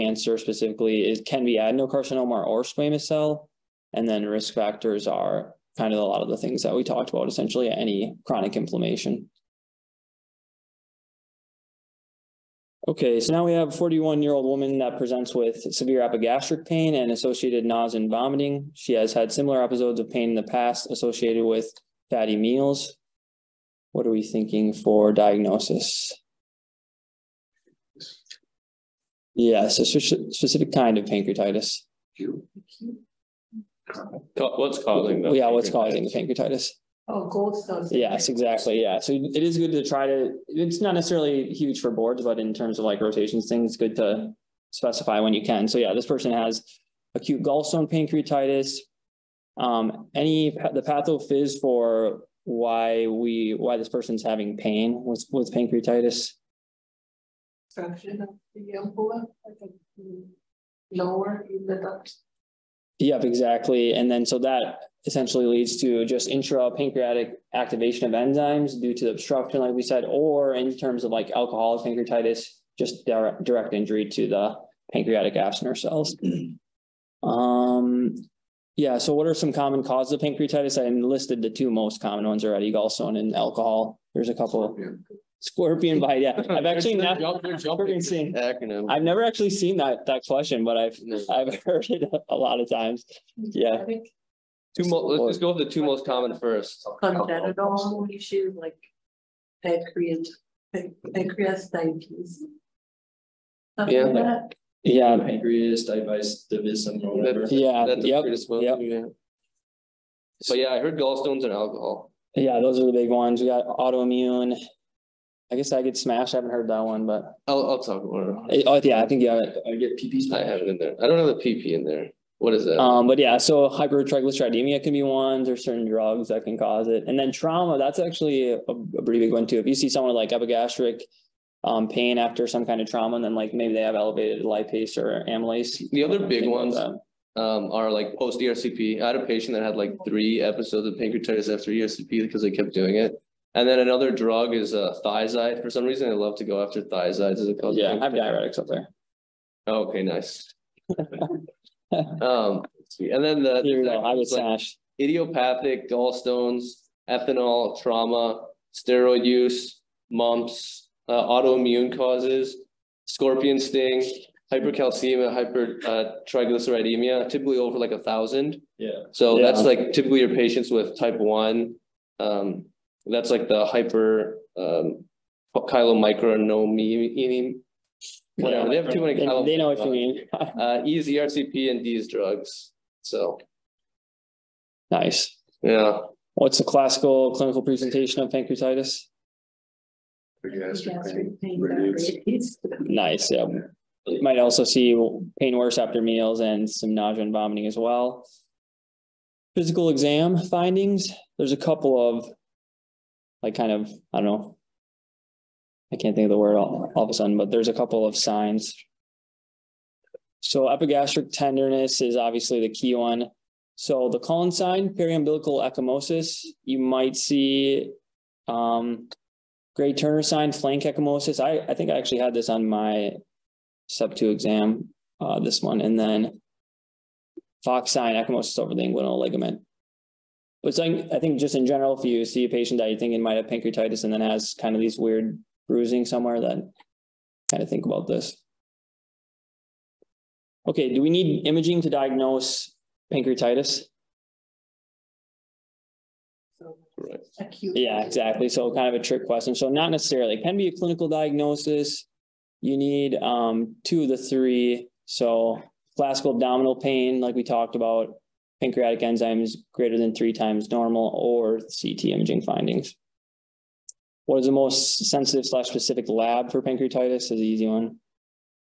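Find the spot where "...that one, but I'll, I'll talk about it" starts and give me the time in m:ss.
1:56.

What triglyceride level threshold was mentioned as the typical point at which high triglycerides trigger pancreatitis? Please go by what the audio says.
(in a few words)
Over 1000.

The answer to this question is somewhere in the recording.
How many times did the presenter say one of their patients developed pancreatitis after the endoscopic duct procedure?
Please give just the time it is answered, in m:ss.
2:20.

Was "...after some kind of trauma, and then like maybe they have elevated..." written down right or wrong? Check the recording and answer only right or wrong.
right.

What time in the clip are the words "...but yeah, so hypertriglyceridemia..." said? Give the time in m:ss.
2:03.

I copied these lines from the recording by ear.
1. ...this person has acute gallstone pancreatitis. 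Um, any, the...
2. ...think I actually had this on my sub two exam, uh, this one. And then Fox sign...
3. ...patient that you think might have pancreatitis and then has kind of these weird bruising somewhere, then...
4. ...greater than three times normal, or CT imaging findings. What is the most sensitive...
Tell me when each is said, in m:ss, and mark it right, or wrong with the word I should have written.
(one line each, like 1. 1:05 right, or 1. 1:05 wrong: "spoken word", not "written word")
1. 0:45 right
2. 3:41 right
3. 3:52 right
4. 4:19 right.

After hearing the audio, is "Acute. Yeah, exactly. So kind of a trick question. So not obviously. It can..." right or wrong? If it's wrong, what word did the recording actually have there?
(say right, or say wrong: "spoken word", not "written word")
wrong: "necessarily", not "obviously".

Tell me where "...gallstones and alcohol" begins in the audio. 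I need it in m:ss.
1:50.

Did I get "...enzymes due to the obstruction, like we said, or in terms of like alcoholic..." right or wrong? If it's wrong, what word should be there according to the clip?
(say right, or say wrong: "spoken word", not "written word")
right.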